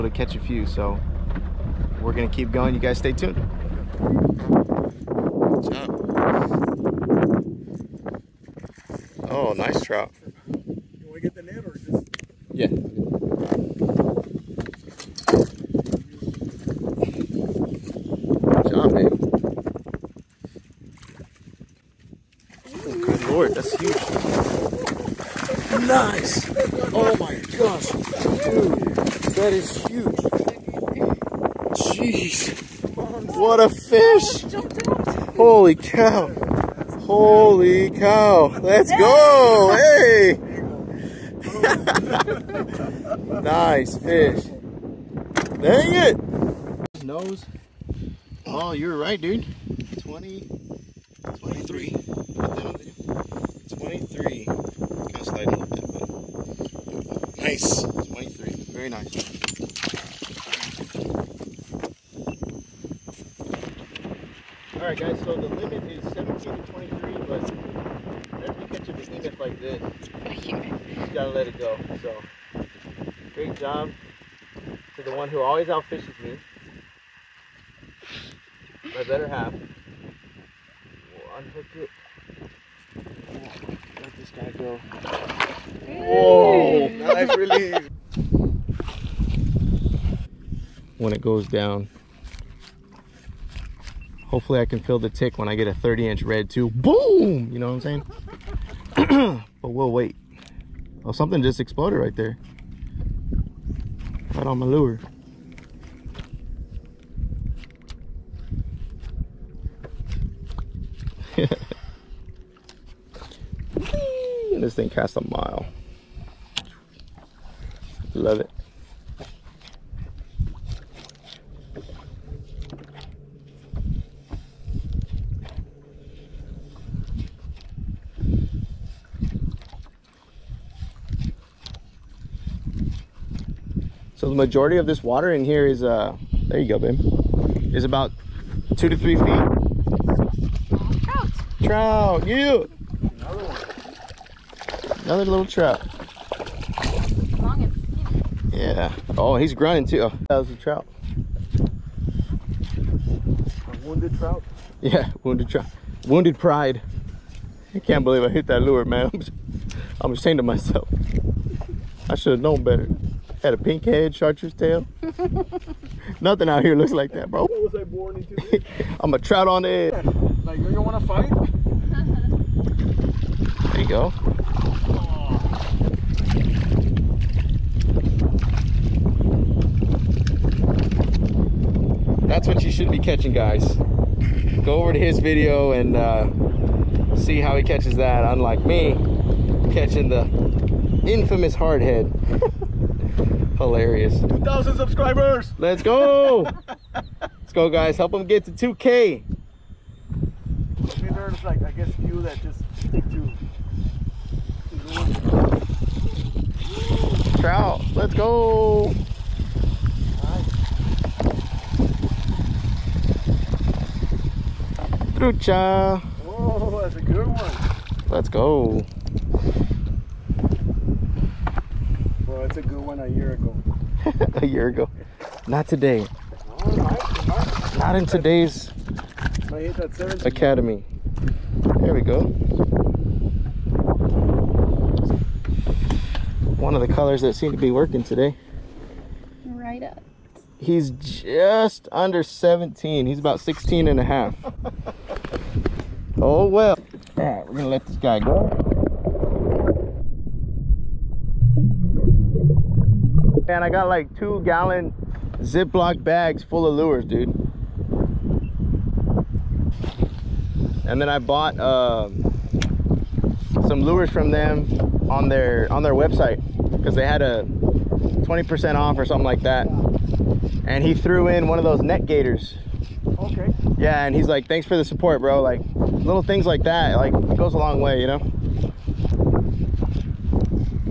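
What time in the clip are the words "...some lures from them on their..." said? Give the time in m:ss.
4:23.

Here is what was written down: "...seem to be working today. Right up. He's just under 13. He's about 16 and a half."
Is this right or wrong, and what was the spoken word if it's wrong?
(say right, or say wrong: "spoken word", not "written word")
wrong: "17", not "13".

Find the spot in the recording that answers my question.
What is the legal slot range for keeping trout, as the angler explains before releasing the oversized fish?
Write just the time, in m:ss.
1:06.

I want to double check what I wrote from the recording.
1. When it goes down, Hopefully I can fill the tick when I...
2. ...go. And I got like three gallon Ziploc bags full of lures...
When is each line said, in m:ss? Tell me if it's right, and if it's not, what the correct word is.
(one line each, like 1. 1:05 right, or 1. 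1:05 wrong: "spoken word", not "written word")
1. 1:30 right
2. 4:08 wrong: "two", not "three".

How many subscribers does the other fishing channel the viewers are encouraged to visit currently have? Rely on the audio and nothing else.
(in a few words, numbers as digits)
2,000.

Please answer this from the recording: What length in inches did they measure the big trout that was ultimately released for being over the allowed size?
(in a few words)
23.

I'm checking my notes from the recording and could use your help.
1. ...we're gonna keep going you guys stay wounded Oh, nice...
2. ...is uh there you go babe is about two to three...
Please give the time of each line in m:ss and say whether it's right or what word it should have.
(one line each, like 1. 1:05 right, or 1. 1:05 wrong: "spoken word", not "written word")
1. 0:02 wrong: "tuned", not "wounded"
2. 2:15 right.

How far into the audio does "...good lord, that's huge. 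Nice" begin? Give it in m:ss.
0:23.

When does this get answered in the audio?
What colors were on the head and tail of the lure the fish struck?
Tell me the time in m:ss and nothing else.
2:43.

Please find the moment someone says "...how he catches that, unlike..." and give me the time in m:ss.
3:07.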